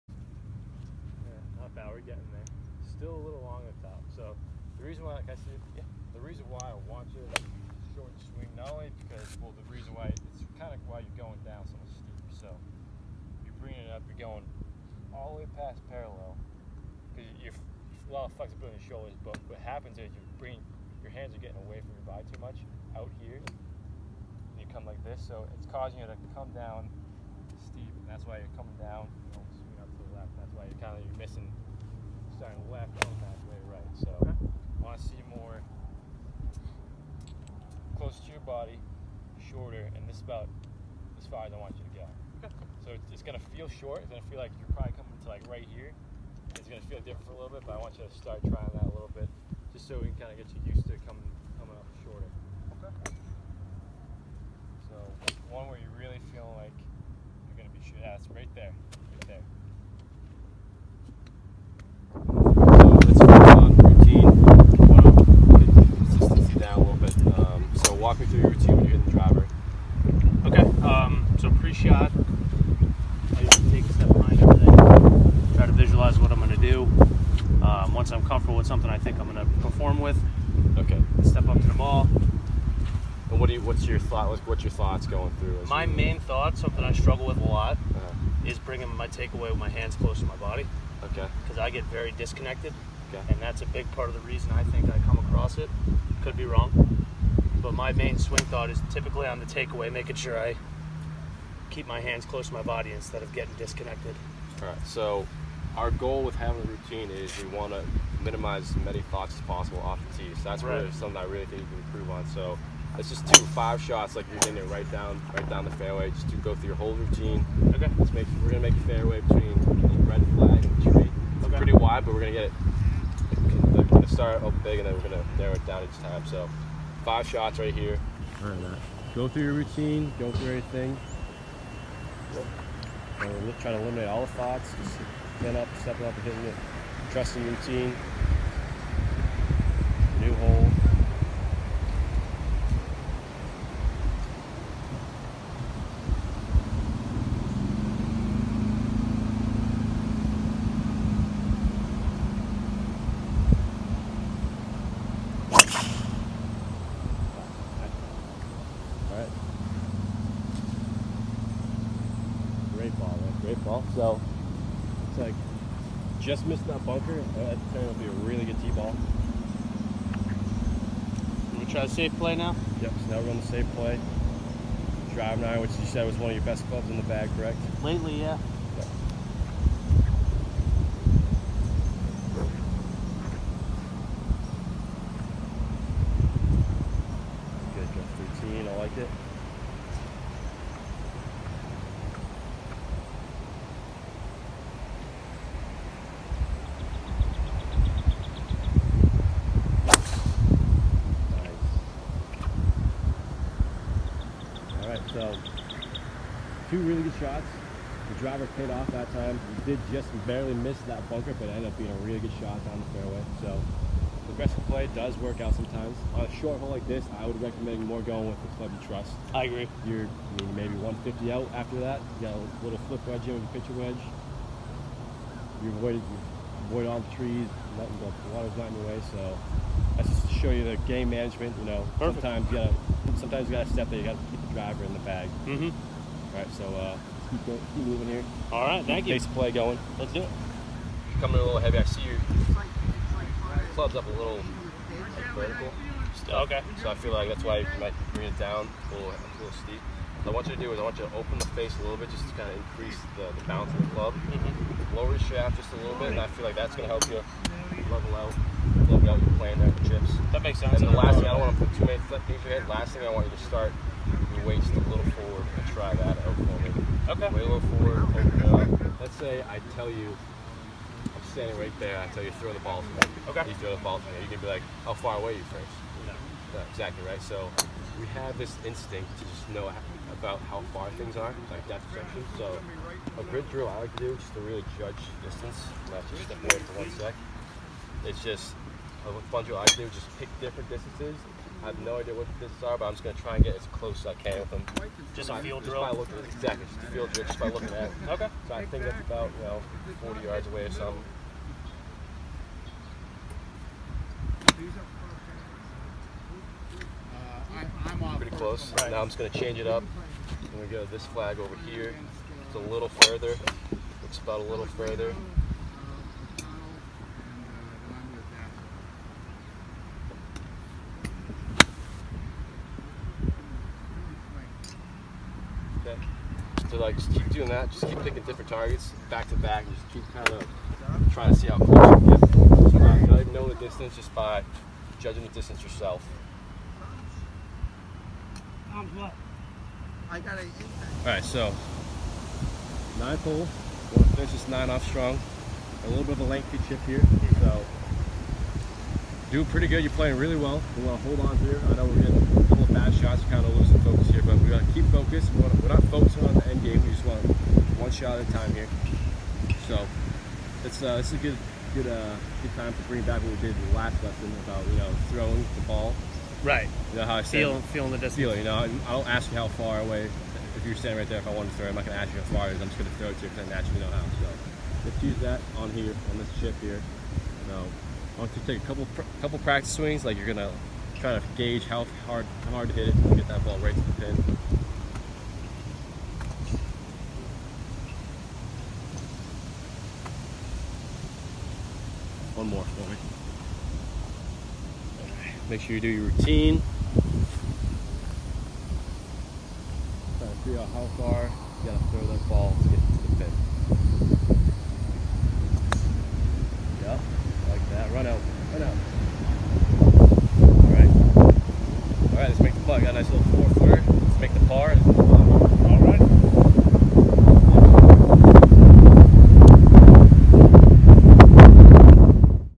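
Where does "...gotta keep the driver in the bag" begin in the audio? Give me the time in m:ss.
3:54.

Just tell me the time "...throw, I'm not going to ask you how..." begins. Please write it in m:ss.
6:11.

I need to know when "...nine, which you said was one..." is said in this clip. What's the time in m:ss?
2:55.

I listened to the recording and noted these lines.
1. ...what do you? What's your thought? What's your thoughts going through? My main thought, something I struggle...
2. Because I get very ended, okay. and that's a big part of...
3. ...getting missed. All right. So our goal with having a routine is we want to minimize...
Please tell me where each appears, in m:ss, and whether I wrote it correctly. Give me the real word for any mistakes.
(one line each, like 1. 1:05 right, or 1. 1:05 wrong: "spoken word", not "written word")
1. 1:23 right
2. 1:31 wrong: "disconnected", not "ended"
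3. 1:43 wrong: "disconnected", not "missed".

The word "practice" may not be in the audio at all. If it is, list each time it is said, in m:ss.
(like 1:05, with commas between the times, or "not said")
6:19.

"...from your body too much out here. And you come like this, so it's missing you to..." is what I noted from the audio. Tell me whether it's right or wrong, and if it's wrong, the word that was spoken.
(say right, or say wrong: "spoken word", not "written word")
wrong: "causing", not "missing".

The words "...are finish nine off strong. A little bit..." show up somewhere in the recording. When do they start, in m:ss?
5:44.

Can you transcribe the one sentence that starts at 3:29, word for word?
did just barely miss that bunker, but it ended up being a really good shot down the fairway.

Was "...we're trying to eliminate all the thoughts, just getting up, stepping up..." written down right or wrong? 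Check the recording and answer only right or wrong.
right.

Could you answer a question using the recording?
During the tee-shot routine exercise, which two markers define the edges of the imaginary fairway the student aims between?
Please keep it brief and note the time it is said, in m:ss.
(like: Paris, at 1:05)
red flag and tree, at 2:00.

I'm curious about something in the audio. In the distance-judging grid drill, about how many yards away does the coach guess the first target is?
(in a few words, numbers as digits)
40 yards.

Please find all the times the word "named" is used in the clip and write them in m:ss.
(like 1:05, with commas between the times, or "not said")
not said.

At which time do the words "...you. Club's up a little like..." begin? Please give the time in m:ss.
4:02.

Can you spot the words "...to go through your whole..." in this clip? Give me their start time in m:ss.
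1:56.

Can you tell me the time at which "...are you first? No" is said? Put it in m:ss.
4:35.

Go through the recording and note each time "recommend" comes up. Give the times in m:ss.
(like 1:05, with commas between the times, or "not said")
3:37.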